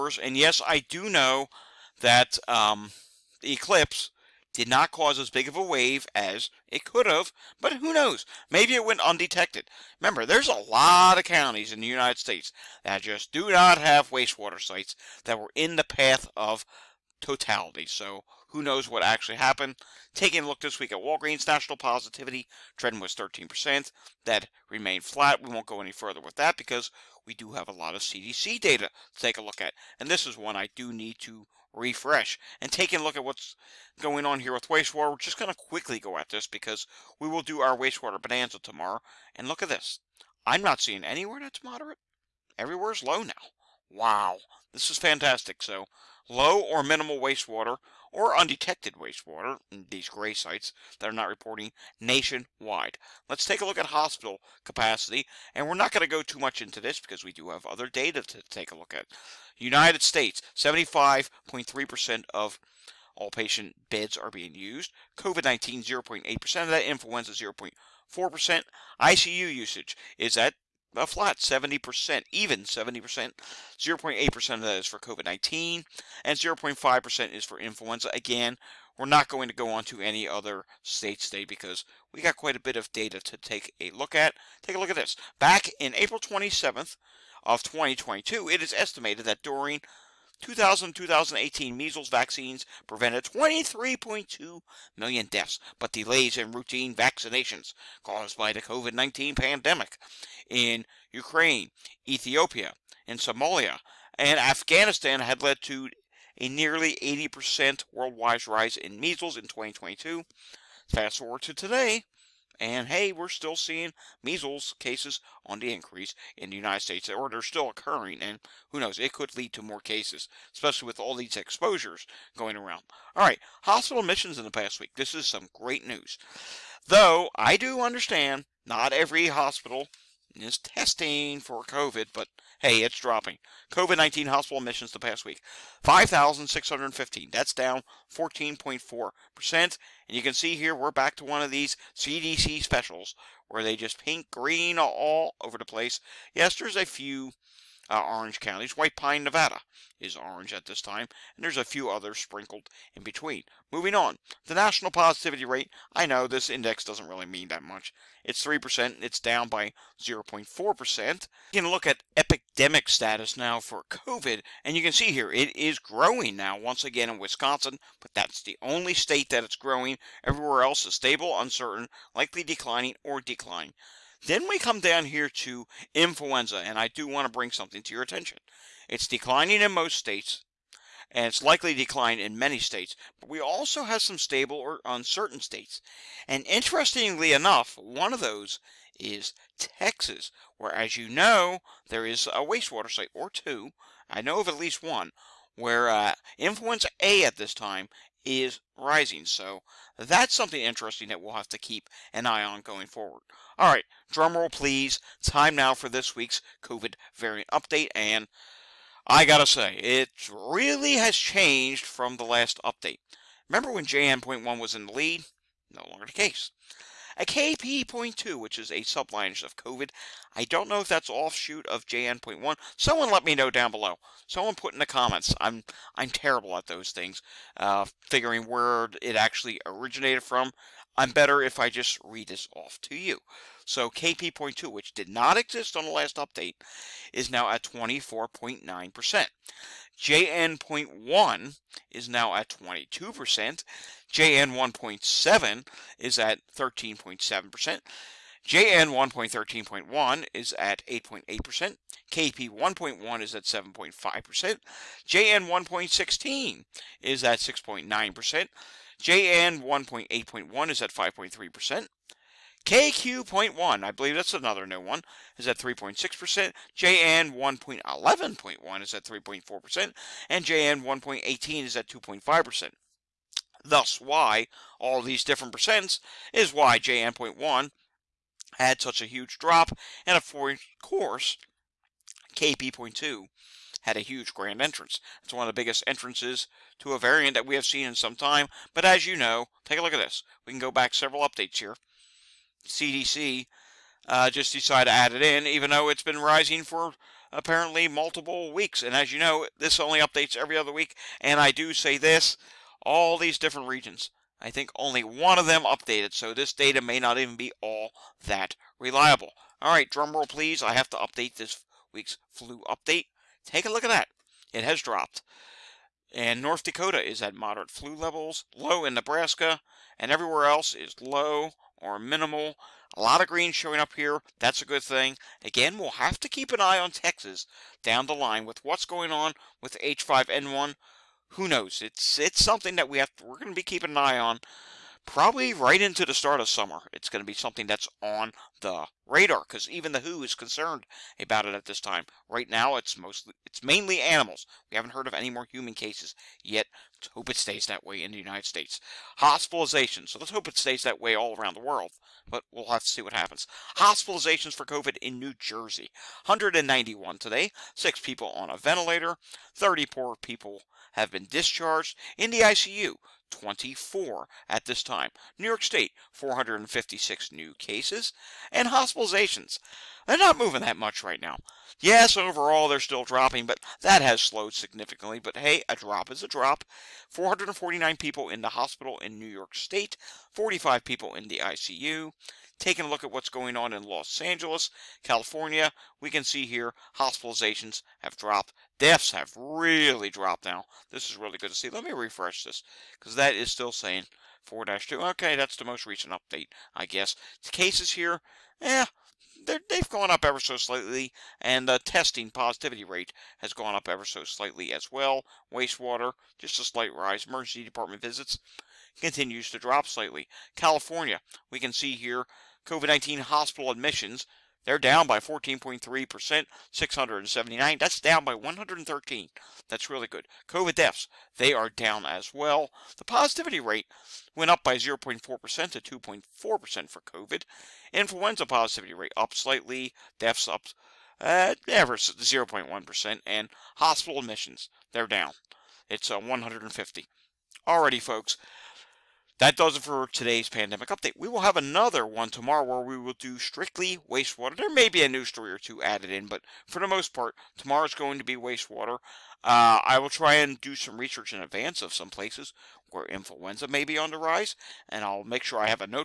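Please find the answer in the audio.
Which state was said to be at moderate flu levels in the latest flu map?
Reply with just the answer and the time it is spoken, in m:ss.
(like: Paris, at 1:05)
North Dakota, at 5:16.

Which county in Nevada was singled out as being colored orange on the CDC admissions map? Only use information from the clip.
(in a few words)
White Pine.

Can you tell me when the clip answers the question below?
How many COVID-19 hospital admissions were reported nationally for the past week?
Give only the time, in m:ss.
2:15.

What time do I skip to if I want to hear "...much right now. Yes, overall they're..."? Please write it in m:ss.
6:10.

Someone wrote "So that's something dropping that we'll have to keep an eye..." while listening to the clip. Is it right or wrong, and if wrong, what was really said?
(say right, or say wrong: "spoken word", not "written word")
wrong: "interesting", not "dropping".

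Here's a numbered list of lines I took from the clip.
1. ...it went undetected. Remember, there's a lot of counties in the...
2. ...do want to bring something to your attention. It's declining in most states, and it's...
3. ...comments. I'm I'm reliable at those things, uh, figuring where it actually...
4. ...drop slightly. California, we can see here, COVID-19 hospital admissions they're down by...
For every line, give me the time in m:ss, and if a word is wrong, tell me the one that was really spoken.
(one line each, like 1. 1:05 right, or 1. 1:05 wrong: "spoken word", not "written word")
1. 0:08 right
2. 2:56 right
3. 3:44 wrong: "terrible", not "reliable"
4. 6:49 right.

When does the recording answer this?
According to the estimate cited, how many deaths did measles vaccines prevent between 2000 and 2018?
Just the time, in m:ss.
1:33.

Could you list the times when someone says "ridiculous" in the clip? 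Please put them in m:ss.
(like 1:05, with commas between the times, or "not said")
not said.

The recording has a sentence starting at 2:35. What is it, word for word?
I know this index doesn't really mean that much.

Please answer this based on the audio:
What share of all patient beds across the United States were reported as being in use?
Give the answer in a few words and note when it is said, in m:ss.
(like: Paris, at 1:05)
75.3%, at 1:00.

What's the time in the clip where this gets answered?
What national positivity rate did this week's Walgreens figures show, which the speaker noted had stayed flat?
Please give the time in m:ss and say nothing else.
0:23.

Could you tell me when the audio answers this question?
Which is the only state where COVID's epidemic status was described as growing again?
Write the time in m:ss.
2:47.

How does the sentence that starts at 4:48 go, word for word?
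But as you know, take a look at this.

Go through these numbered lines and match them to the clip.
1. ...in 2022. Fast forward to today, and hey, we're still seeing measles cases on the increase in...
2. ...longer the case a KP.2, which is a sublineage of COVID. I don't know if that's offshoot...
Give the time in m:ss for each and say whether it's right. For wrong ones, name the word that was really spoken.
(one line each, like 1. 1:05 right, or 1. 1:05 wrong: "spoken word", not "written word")
1. 1:49 right
2. 3:35 right.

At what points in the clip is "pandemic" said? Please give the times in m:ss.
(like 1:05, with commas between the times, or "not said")
1:39, 7:20.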